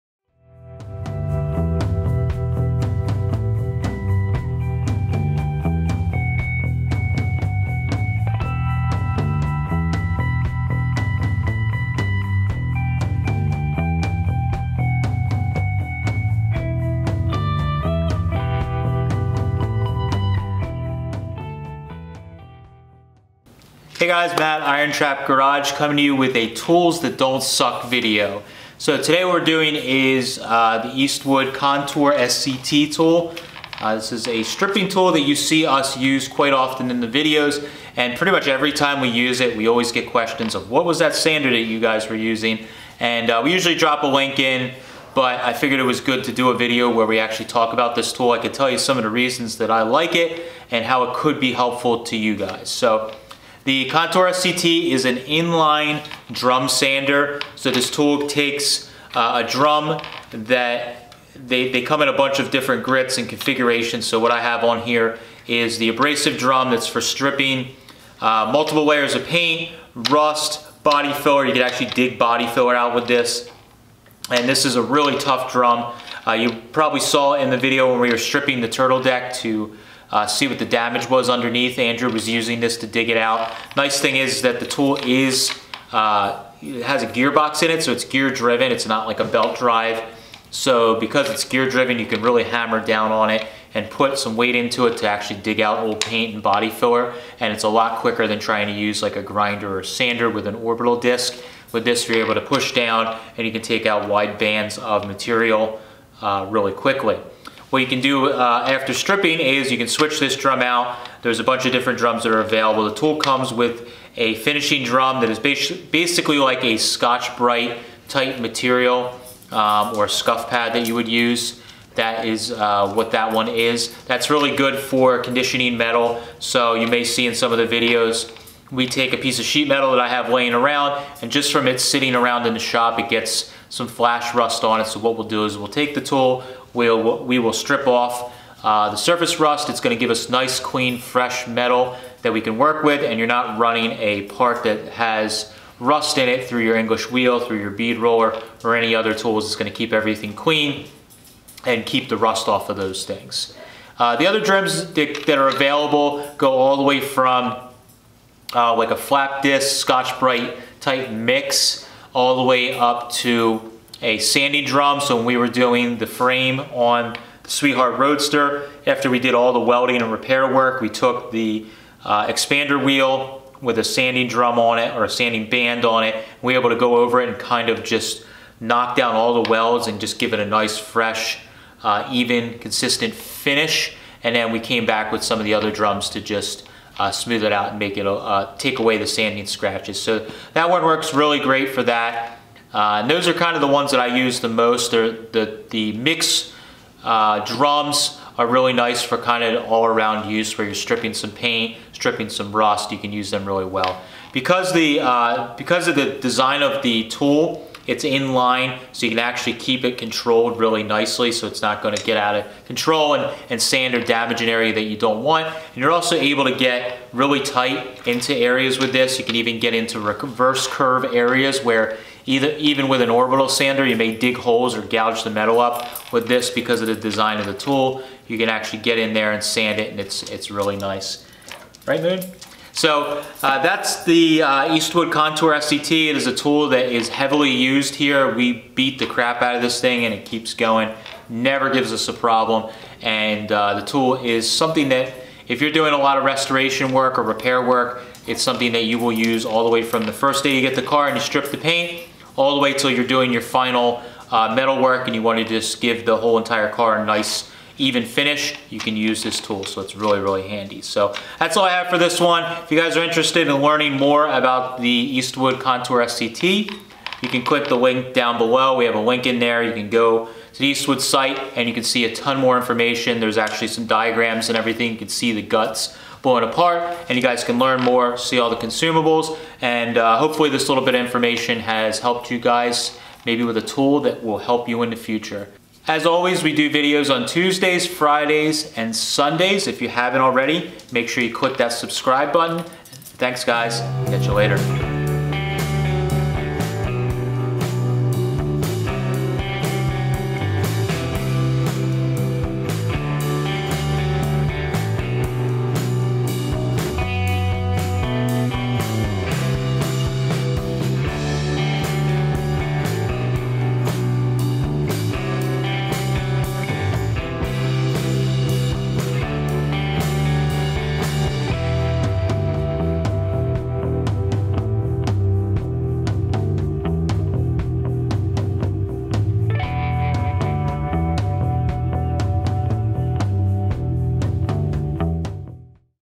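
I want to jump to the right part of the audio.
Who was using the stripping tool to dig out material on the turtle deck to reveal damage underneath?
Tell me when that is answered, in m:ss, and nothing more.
1:21.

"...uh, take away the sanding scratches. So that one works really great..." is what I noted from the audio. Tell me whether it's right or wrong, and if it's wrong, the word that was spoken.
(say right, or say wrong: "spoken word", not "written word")
right.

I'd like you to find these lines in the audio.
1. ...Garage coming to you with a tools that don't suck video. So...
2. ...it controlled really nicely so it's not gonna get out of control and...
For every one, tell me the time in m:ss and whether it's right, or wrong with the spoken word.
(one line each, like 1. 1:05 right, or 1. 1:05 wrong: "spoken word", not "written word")
1. 0:25 right
2. 3:29 right.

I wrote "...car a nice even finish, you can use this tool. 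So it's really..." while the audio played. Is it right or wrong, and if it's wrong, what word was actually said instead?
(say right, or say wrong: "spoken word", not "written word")
right.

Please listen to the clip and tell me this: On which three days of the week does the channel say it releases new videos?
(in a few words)
Tuesdays, Fridays, and Sundays.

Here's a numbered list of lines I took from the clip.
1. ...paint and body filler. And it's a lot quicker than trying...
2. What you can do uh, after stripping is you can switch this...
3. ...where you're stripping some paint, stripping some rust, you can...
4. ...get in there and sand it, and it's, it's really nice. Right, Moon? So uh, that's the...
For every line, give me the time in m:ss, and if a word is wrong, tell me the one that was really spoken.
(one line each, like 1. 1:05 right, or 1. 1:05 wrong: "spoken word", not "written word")
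1. 1:36 right
2. 1:47 right
3. 3:20 right
4. 3:48 right.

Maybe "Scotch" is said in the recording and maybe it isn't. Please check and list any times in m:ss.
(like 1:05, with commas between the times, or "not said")
1:56, 2:39.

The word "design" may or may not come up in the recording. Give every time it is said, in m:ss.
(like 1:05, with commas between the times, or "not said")
3:26, 3:46.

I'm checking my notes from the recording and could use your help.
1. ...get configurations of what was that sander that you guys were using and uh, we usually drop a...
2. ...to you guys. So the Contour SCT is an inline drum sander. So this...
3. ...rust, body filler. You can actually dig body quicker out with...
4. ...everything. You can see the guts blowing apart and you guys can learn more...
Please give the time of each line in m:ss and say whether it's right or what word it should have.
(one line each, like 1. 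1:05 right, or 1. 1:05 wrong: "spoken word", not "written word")
1. 0:39 wrong: "questions", not "configurations"
2. 0:52 right
3. 1:09 wrong: "filler", not "quicker"
4. 4:34 right.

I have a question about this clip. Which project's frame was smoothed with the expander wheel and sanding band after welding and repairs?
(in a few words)
Sweetheart Roadster.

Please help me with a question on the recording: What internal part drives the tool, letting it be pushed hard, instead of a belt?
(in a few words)
Gearbox.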